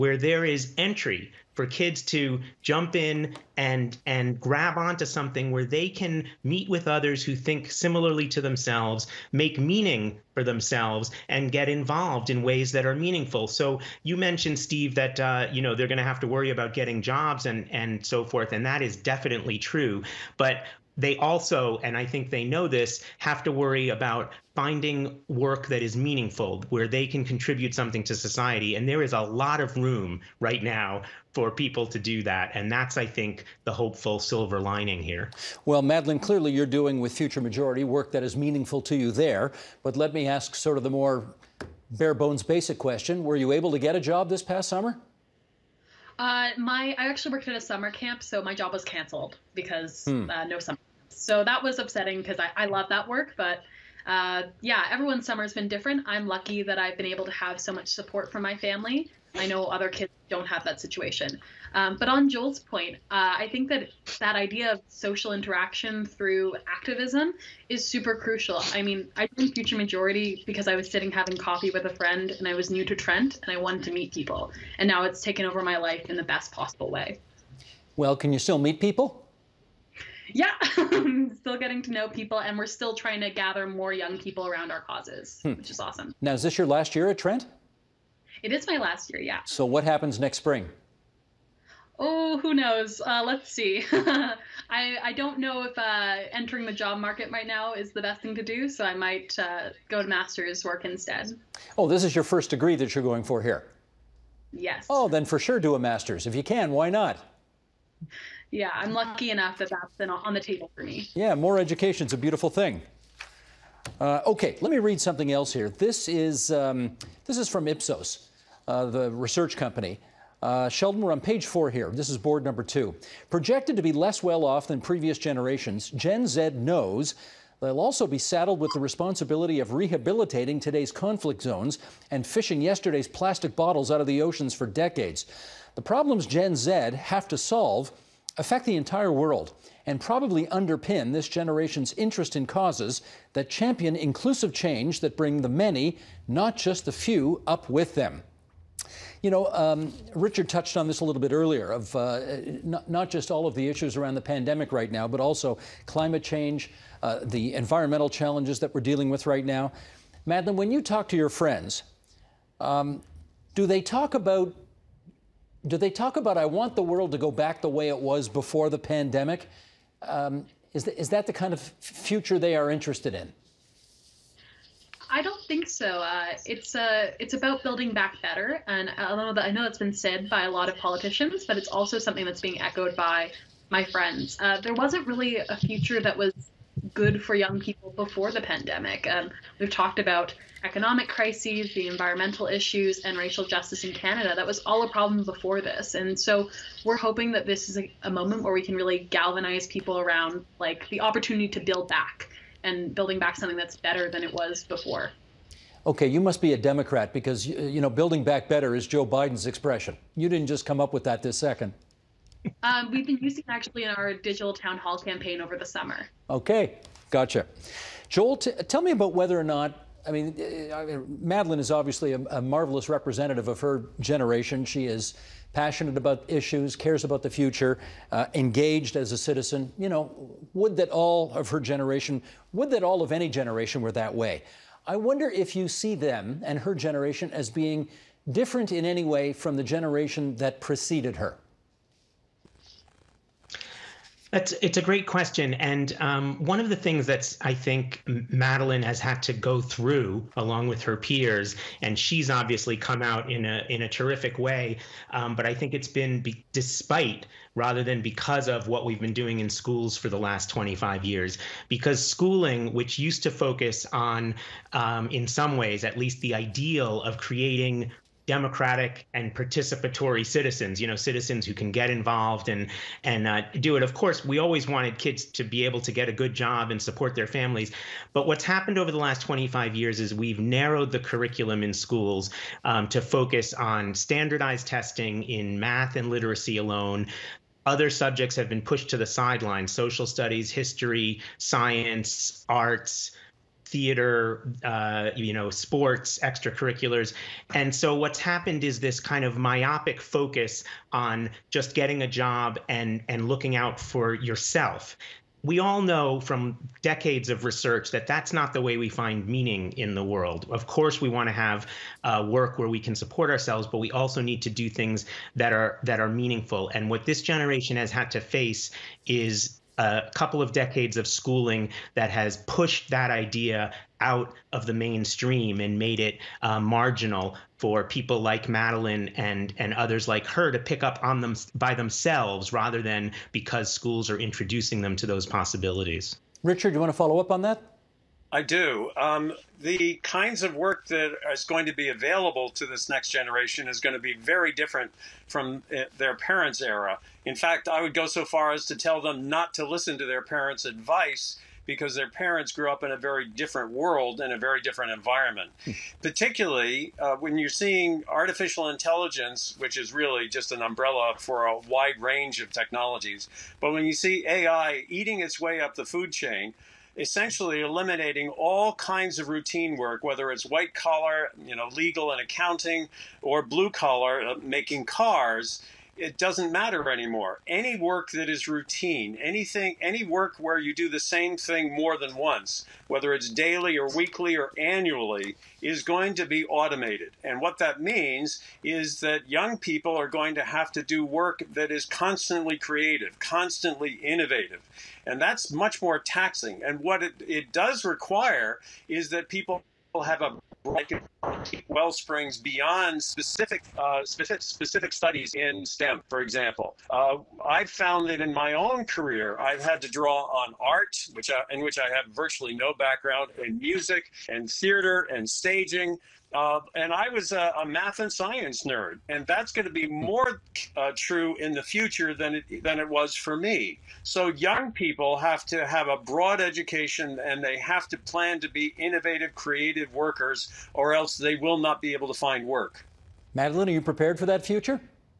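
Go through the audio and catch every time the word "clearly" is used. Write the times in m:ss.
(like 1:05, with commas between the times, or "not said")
0:36.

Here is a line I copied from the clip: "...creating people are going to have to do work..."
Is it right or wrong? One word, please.
wrong.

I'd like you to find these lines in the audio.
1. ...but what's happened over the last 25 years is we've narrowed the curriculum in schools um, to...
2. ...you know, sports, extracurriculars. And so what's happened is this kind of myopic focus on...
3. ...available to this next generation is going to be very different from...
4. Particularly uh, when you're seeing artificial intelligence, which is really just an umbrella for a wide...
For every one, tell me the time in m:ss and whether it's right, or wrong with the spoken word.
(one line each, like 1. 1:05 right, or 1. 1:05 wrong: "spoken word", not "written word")
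1. 4:38 right
2. 4:55 right
3. 5:41 right
4. 5:56 right.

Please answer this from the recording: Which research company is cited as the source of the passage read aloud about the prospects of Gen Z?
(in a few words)
Ipsos.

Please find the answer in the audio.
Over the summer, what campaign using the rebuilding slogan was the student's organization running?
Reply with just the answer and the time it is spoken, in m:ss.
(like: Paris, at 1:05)
Digital town hall, at 3:34.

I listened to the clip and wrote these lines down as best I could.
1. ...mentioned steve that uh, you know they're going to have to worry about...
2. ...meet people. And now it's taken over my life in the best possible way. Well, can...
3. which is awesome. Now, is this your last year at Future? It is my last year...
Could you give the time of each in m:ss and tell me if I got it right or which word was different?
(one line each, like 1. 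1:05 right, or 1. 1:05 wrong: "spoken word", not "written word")
1. 0:14 right
2. 1:13 right
3. 1:25 wrong: "Trent", not "Future".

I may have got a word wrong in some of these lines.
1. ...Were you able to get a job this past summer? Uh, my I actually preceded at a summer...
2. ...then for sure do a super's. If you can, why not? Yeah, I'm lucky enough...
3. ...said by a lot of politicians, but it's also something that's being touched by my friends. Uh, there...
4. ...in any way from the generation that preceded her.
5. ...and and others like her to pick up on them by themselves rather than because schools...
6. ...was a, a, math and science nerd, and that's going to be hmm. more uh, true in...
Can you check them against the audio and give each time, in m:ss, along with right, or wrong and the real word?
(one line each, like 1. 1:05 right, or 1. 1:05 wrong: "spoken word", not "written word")
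1. 0:43 wrong: "worked", not "preceded"
2. 1:45 wrong: "master", not "super"
3. 2:59 wrong: "echoed", not "touched"
4. 3:58 right
5. 5:29 right
6. 6:57 right.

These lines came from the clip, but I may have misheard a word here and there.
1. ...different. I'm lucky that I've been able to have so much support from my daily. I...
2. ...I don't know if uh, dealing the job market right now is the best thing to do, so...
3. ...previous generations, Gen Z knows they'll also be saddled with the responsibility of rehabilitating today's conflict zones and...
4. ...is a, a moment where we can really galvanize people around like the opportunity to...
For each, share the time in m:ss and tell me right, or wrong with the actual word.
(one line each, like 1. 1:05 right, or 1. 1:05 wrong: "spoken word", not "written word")
1. 0:55 wrong: "family", not "daily"
2. 1:35 wrong: "entering", not "dealing"
3. 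2:04 right
4. 3:17 right.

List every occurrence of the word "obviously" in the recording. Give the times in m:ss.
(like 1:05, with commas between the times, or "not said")
3:41, 4:12.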